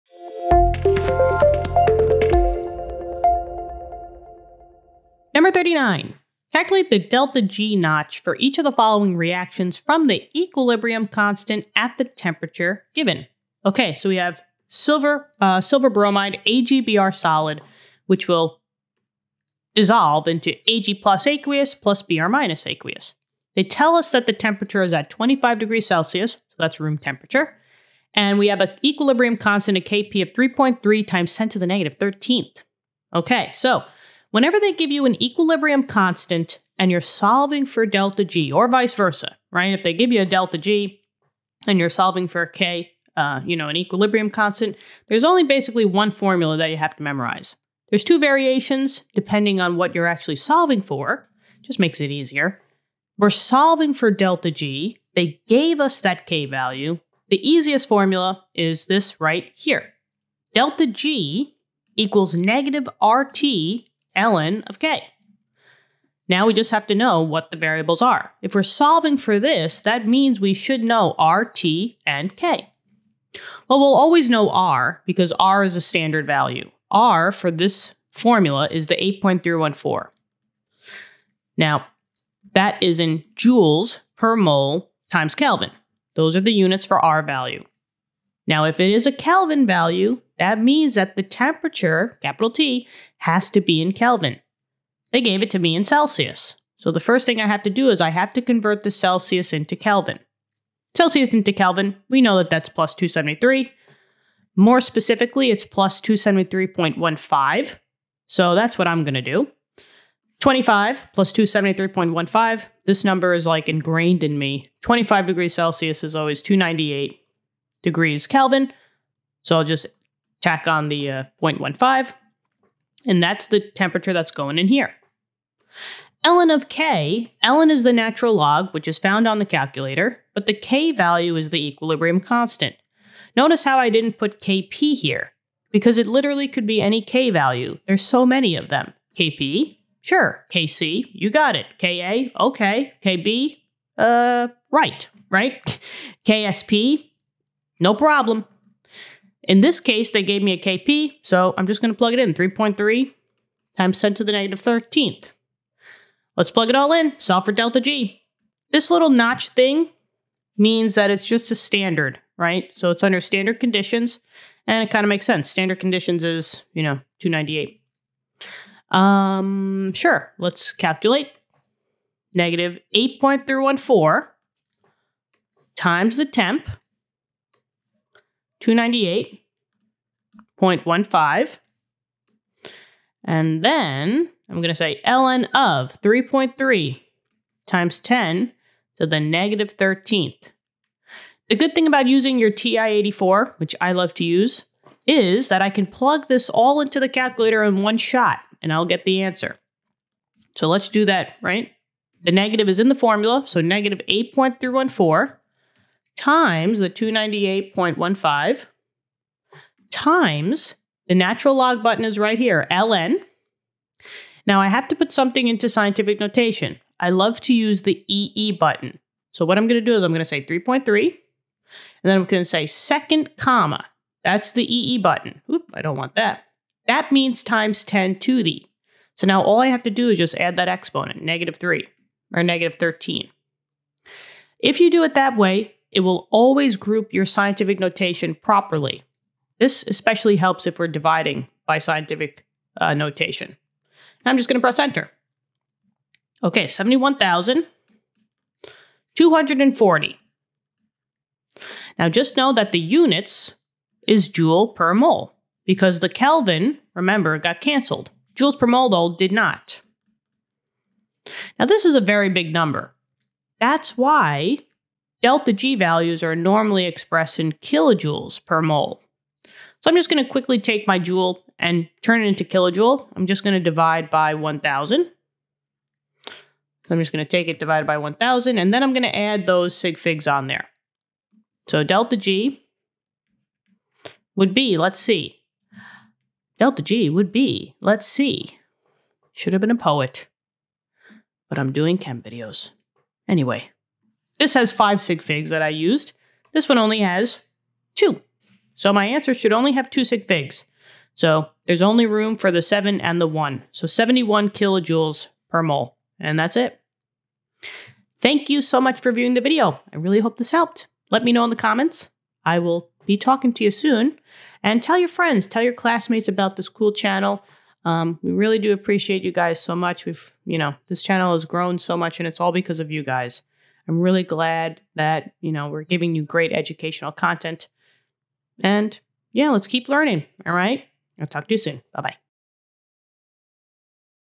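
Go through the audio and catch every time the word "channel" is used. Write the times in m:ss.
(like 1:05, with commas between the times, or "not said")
5:16, 5:21.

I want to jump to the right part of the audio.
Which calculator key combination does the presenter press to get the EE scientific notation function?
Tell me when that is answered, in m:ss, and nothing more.
3:42.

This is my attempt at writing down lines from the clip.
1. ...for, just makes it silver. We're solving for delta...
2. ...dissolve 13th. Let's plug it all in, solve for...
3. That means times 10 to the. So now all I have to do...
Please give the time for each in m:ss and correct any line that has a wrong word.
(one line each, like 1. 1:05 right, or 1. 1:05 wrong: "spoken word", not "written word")
1. 0:50 wrong: "easier", not "silver"
2. 2:34 wrong: "negative", not "dissolve"
3. 3:46 right.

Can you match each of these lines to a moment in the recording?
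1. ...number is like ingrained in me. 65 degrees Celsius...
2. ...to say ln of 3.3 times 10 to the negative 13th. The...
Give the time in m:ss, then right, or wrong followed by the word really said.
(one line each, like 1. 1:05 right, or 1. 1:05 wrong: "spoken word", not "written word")
1. 1:53 wrong: "25", not "65"
2. 3:04 right.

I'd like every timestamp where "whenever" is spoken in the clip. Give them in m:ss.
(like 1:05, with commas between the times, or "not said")
0:34.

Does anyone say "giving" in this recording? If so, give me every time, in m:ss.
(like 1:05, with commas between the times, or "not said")
5:25.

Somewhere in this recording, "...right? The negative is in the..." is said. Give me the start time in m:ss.
3:21.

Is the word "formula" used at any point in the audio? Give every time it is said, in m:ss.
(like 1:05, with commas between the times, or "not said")
0:46, 0:57, 1:18, 3:22.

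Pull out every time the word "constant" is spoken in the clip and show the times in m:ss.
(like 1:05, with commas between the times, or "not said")
0:11, 0:29, 0:35, 0:44, 2:12.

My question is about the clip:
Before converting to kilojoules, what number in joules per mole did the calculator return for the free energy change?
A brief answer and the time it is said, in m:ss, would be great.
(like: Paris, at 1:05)
71,240, at 4:06.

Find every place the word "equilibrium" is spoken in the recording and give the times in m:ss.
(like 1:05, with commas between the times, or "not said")
0:10, 0:28, 0:35, 0:43, 2:11.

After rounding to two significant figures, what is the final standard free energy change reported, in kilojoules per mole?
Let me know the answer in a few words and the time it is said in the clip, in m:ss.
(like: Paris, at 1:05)
71, at 5:03.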